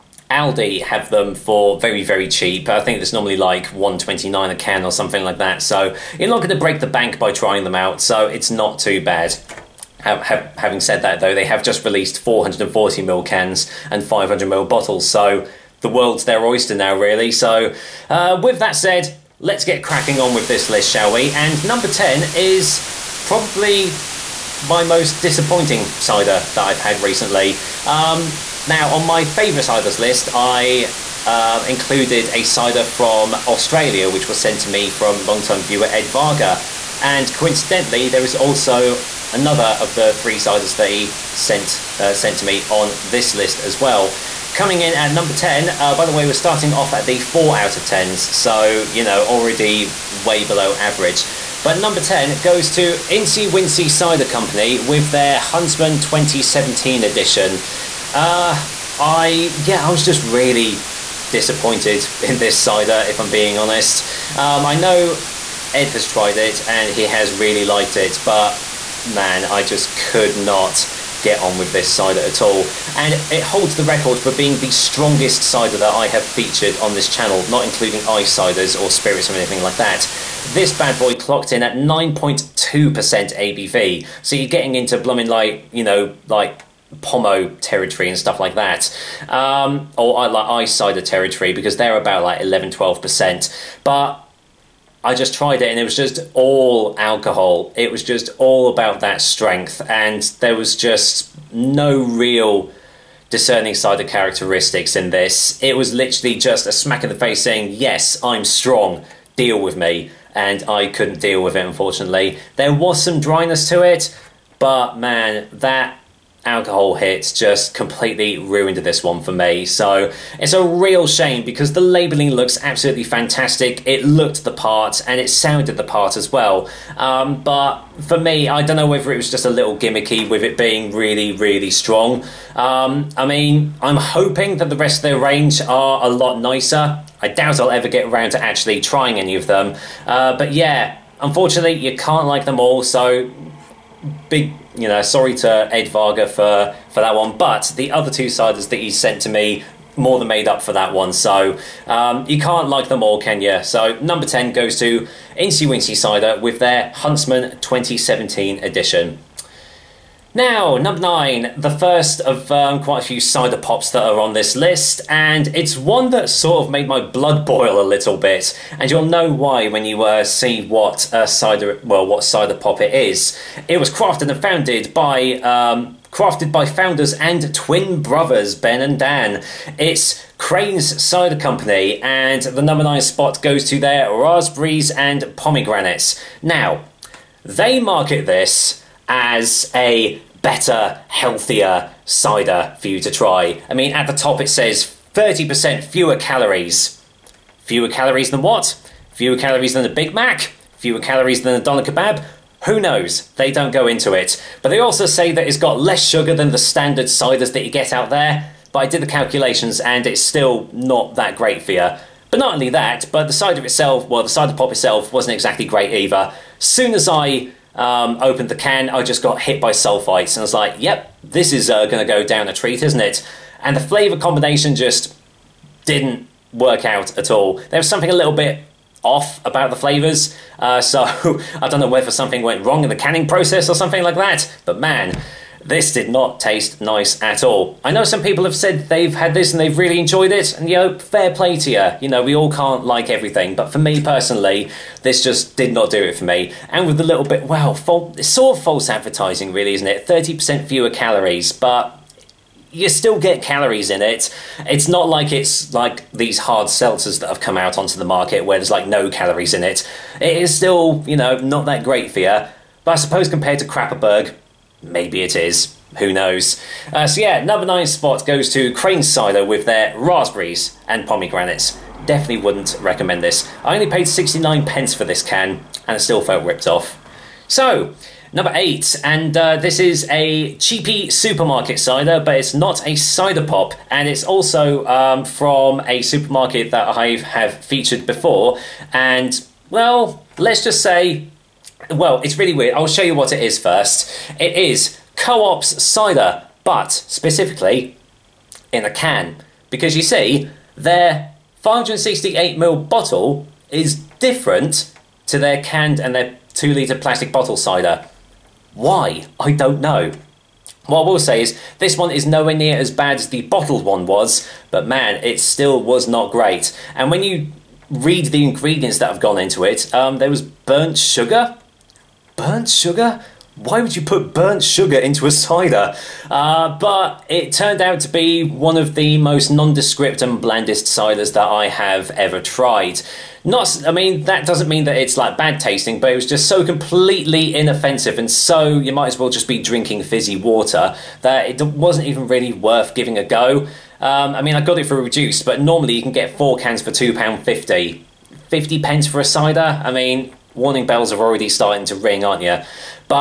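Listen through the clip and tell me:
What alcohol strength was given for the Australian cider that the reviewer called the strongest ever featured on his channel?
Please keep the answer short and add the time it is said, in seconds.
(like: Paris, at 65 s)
9.2% ABV, at 81 s.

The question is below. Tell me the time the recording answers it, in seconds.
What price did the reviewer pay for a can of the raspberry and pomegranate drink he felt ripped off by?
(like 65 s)
274 s.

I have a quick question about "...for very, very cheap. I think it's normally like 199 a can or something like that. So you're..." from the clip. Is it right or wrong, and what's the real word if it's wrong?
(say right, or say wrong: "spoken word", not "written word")
wrong: "129", not "199".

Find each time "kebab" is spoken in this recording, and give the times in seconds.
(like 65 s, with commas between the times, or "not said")
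201 s.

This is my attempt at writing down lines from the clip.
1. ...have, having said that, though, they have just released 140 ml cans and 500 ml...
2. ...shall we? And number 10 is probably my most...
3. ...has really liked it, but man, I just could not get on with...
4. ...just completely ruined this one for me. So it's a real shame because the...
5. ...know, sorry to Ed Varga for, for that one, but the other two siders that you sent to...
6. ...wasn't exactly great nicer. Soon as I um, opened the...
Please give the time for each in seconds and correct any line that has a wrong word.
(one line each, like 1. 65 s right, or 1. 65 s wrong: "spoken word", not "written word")
1. 10 s wrong: "440", not "140"
2. 20 s right
3. 67 s right
4. 117 s right
5. 144 s right
6. 215 s wrong: "either", not "nicer".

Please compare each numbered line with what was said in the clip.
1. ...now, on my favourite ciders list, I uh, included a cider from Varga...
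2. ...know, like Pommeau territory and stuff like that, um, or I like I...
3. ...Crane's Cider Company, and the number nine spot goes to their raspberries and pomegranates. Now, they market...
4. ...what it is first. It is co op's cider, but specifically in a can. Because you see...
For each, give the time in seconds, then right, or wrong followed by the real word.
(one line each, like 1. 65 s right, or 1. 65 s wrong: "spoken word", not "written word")
1. 28 s wrong: "Australia", not "Varga"
2. 85 s right
3. 180 s right
4. 293 s right.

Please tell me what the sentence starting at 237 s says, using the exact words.
I know some people have said they've had this and they've really enjoyed it, and you know, fair play to you.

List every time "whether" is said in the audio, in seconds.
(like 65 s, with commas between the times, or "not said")
128 s, 231 s.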